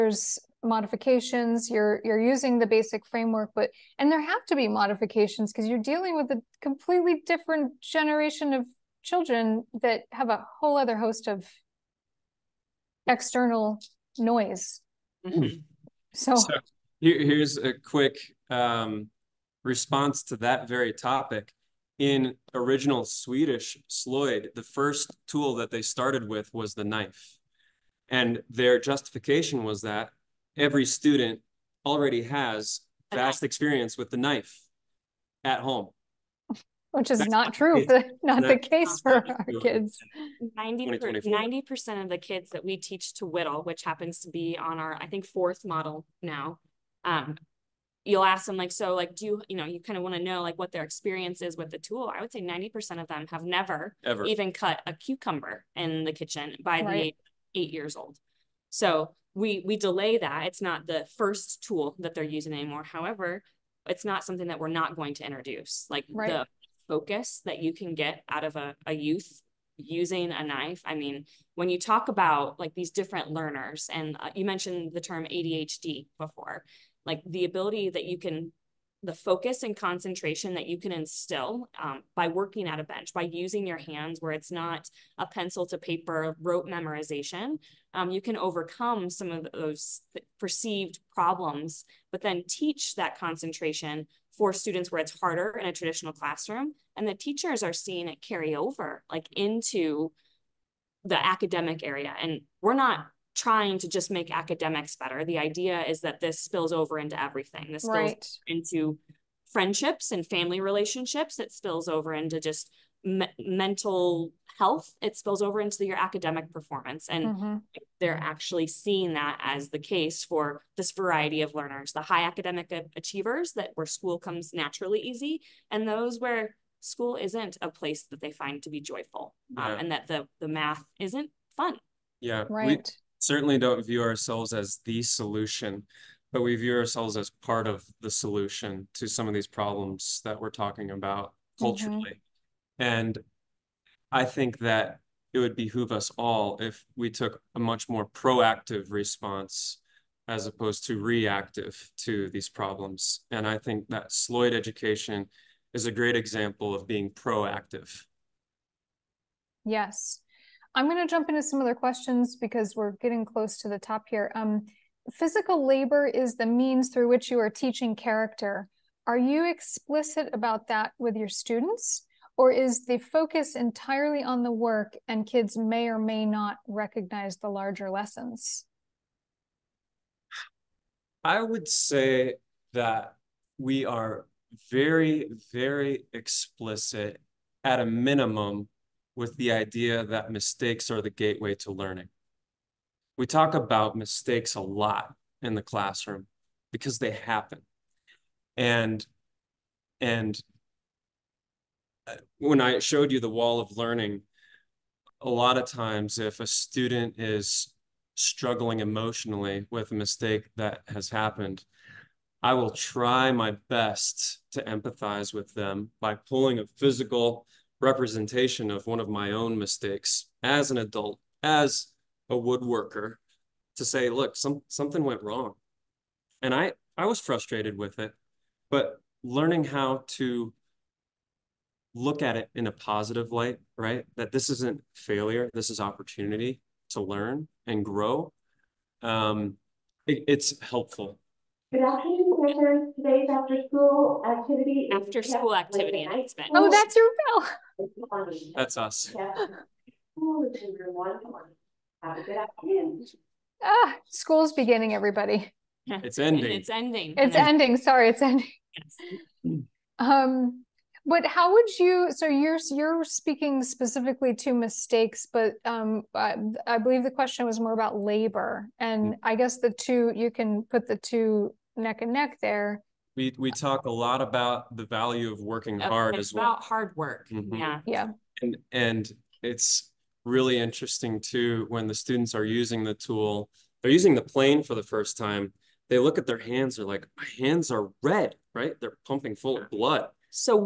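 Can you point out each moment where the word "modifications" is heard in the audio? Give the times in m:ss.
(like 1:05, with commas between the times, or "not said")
0:00, 0:04.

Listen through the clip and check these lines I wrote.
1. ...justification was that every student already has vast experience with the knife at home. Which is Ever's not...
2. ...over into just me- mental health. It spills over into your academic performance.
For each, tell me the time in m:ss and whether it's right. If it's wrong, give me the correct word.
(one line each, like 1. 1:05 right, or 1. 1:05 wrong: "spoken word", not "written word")
1. 0:28 wrong: "That", not "Ever"
2. 1:51 right.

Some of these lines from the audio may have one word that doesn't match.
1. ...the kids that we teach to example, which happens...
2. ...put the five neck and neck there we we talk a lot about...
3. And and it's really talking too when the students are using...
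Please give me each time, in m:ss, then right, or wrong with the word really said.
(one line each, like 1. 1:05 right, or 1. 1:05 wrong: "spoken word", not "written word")
1. 0:42 wrong: "whittle", not "example"
2. 4:30 wrong: "two", not "five"
3. 4:38 wrong: "interesting", not "talking".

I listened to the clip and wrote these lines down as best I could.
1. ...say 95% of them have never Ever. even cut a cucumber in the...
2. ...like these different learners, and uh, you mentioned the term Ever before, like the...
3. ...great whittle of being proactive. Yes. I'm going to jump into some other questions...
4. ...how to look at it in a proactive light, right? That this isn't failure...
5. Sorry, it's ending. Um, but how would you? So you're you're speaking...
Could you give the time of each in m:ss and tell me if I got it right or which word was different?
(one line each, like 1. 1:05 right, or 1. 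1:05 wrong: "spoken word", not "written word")
1. 0:52 wrong: "90", not "95"
2. 1:12 wrong: "ADHD", not "Ever"
3. 2:35 wrong: "example", not "whittle"
4. 3:49 wrong: "positive", not "proactive"
5. 4:17 right.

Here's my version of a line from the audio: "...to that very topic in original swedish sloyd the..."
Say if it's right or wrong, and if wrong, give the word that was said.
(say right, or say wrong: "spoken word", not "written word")
right.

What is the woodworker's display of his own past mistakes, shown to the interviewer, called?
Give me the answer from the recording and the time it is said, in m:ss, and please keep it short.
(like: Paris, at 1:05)
the wall of learning, at 3:23.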